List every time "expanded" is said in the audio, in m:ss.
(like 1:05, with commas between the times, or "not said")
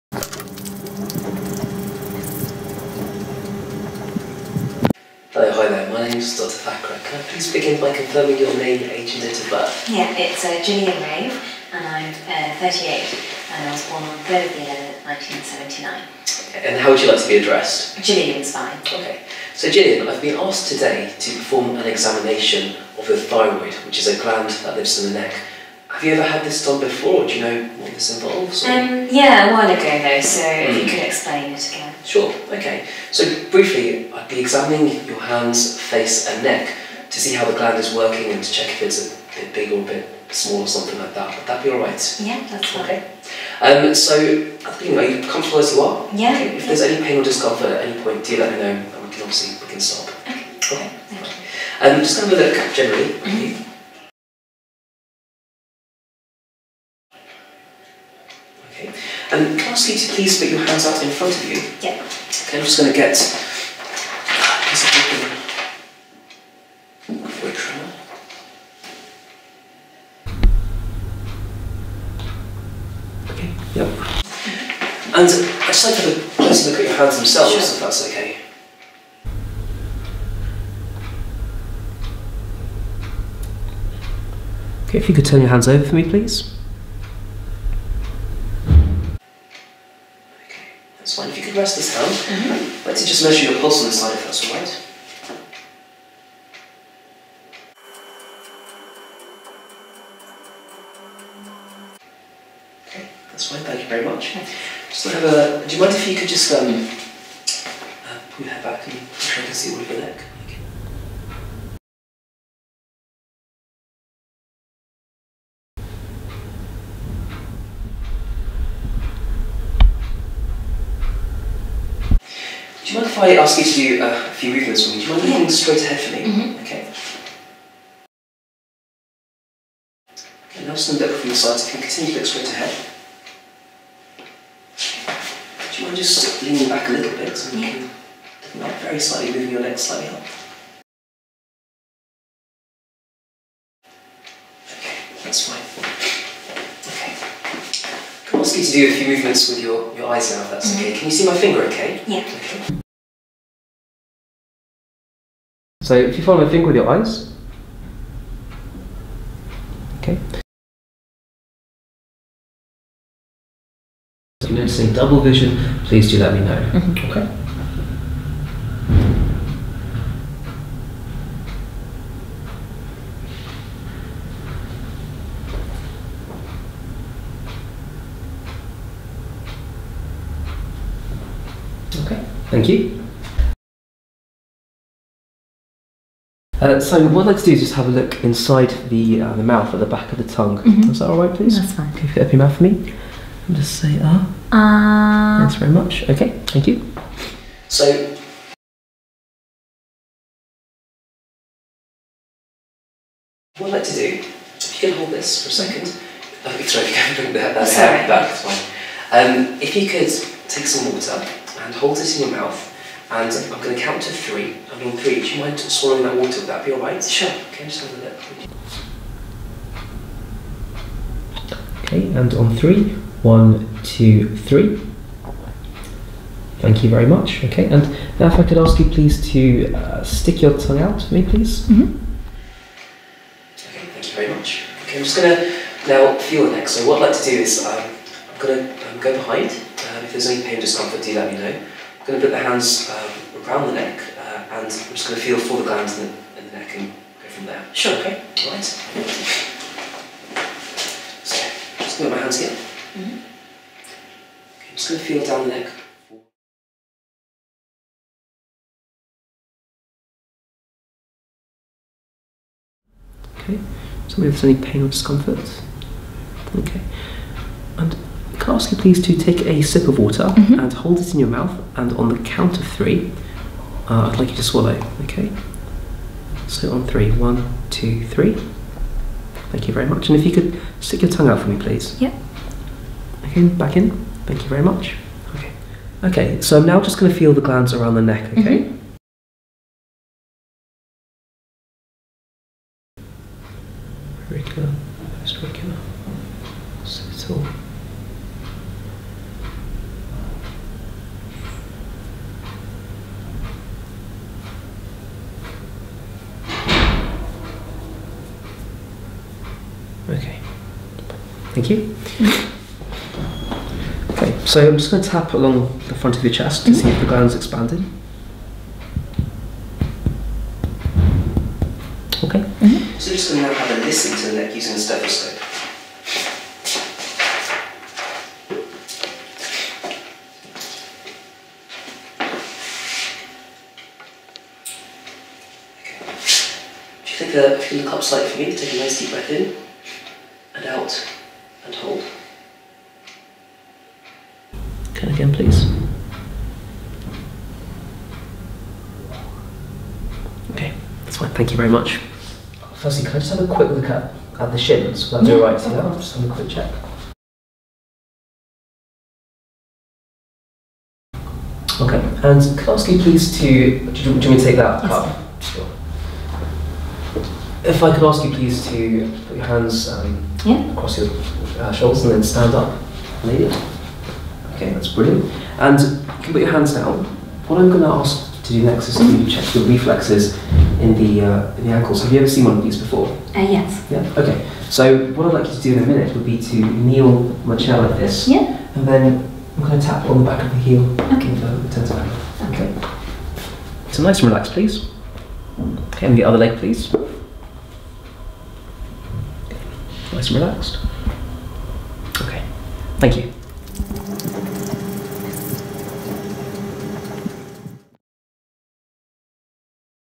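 5:17.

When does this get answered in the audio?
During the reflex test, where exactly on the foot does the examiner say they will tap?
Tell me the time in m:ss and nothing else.
6:30.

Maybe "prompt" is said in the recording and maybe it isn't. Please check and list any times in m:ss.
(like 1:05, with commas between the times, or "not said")
not said.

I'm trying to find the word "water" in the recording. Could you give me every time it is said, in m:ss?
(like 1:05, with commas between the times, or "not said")
3:30, 3:36, 4:29.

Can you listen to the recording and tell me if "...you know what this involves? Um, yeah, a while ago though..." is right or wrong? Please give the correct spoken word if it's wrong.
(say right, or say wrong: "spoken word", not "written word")
right.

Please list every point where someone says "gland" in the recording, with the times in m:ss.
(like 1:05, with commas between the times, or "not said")
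0:24, 0:37, 4:05, 4:47, 5:17.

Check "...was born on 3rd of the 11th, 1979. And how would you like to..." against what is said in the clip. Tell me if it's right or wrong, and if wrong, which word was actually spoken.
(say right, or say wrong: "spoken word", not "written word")
right.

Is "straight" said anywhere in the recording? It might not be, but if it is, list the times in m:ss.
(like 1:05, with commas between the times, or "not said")
2:05, 2:12.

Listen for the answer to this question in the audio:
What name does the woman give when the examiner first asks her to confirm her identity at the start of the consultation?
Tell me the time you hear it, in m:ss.
0:10.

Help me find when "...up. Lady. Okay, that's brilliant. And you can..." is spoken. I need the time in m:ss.
6:12.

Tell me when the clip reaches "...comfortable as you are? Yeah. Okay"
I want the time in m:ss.
0:45.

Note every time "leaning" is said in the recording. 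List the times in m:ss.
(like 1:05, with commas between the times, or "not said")
2:16.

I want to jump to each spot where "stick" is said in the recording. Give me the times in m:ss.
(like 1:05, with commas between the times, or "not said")
3:50, 4:40.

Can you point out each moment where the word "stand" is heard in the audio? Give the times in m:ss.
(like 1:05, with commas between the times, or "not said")
2:10, 6:12.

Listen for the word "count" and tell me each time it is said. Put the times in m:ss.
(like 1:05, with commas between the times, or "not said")
3:33, 4:32.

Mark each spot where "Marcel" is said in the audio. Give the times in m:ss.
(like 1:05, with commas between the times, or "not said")
6:27.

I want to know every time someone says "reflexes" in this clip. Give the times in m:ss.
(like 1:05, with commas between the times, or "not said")
6:19.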